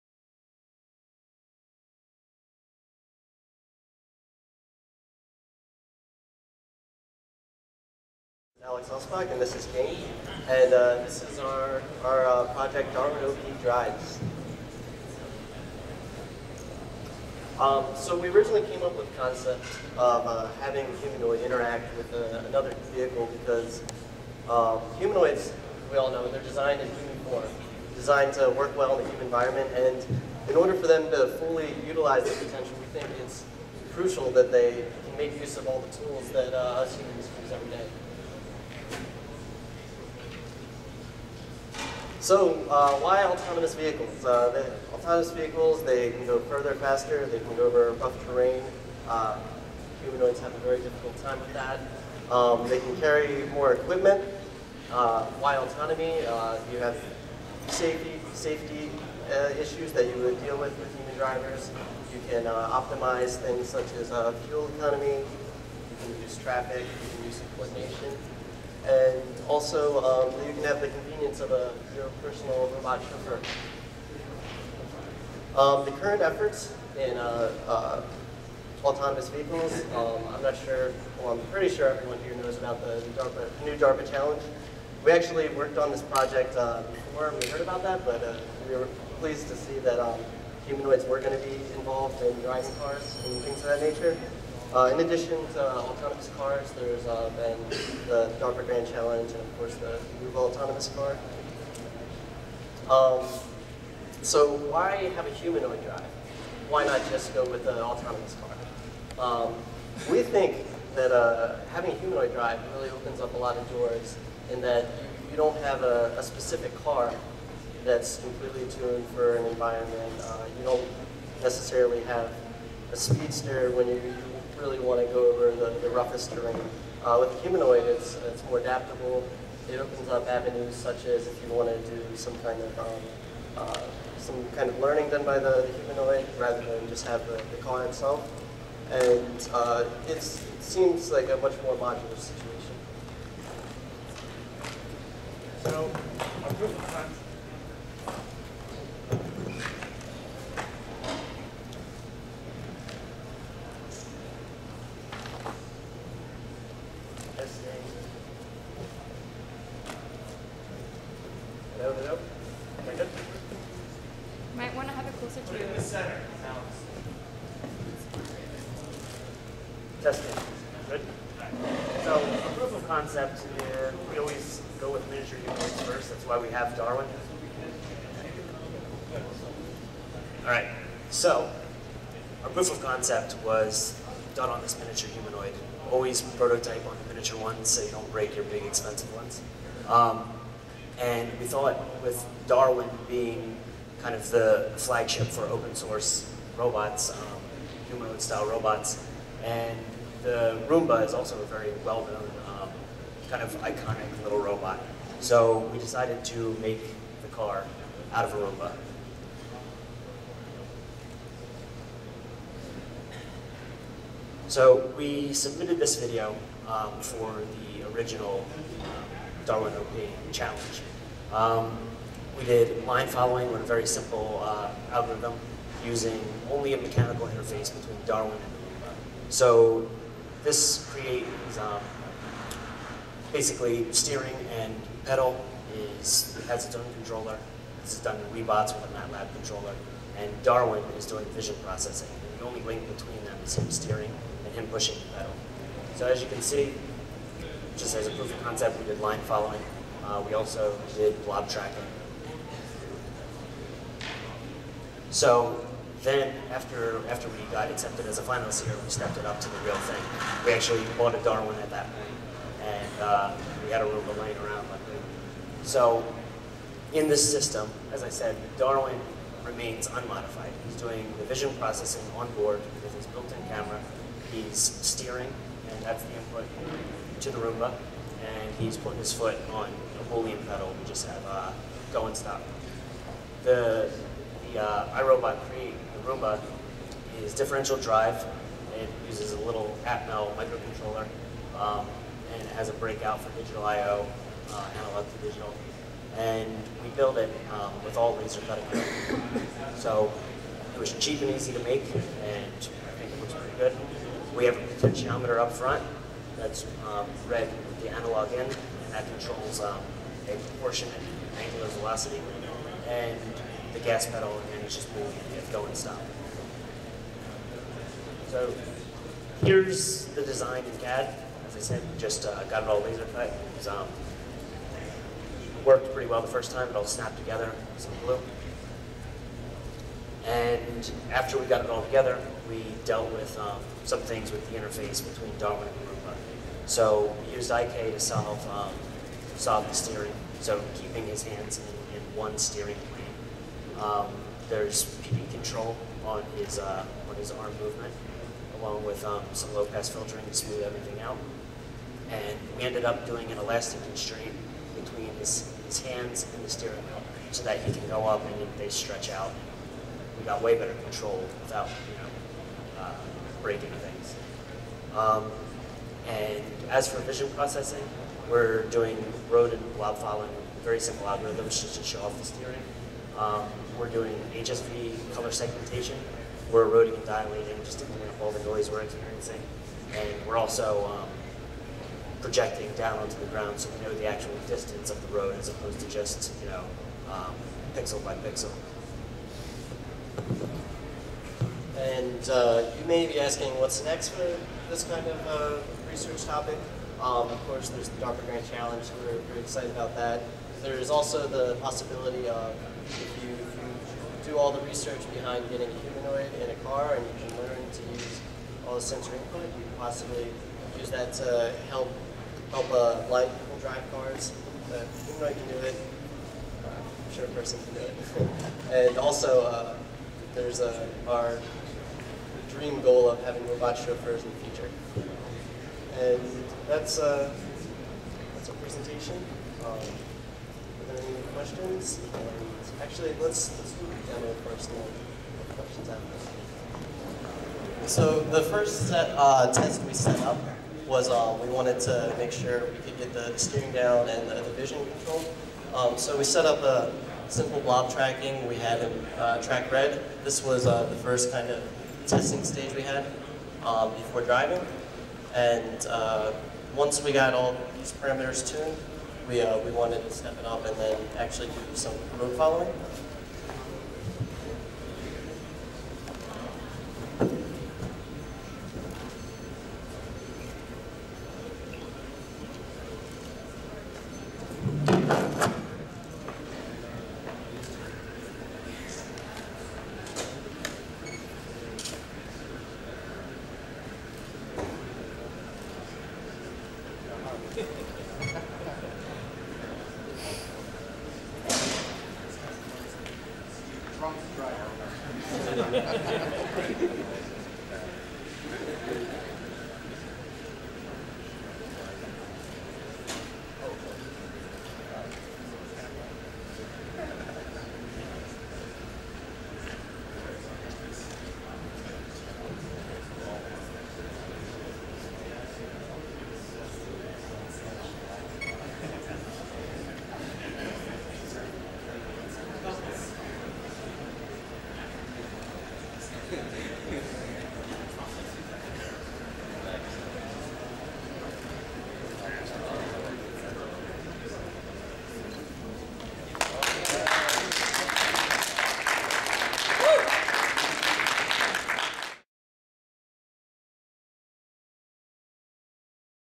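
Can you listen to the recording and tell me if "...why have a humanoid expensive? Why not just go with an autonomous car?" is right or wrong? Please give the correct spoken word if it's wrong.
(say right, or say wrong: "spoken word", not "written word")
wrong: "drive", not "expensive".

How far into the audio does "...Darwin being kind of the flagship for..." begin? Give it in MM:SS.
03:12.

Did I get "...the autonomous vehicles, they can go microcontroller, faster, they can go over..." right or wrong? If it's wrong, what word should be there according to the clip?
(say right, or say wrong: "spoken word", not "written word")
wrong: "further", not "microcontroller".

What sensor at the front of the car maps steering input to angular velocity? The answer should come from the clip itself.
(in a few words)
potentiometer.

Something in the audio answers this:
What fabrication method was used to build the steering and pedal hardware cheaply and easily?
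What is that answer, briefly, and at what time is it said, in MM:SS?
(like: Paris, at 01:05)
laser cutting, at 04:58.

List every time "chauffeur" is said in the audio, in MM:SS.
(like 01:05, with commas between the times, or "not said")
01:12, 07:03.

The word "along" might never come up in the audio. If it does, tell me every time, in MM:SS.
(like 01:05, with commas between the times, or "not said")
05:48.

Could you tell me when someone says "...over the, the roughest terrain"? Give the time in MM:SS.
02:05.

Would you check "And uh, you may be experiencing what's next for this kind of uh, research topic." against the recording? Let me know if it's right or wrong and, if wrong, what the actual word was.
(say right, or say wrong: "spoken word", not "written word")
wrong: "asking", not "experiencing".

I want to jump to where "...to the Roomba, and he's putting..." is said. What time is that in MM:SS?
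04:37.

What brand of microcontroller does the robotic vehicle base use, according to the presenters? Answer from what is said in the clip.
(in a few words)
Atmel.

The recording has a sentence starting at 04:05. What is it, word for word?
So as you can see, just as a proof of concept, we did line following.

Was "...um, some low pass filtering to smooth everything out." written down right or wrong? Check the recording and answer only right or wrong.
right.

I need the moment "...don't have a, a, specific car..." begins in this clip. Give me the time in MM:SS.
01:55.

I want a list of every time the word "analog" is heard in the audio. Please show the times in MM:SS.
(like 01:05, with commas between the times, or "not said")
04:54, 05:07.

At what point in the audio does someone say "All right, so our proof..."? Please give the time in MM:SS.
03:00.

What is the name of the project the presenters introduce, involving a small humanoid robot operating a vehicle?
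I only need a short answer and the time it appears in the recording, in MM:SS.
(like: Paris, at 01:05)
Darwin OP Drives, at 00:12.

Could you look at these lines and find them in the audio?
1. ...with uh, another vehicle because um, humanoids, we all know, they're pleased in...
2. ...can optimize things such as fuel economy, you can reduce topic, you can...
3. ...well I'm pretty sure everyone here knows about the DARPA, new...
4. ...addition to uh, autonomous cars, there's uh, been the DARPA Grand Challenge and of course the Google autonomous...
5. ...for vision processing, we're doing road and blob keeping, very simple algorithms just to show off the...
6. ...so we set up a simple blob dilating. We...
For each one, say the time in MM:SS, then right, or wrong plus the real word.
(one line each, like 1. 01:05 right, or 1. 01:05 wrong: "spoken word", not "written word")
1. 00:21 wrong: "designed", not "pleased"
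2. 01:02 wrong: "traffic", not "topic"
3. 01:21 right
4. 01:35 right
5. 06:06 wrong: "following", not "keeping"
6. 07:25 wrong: "tracking", not "dilating".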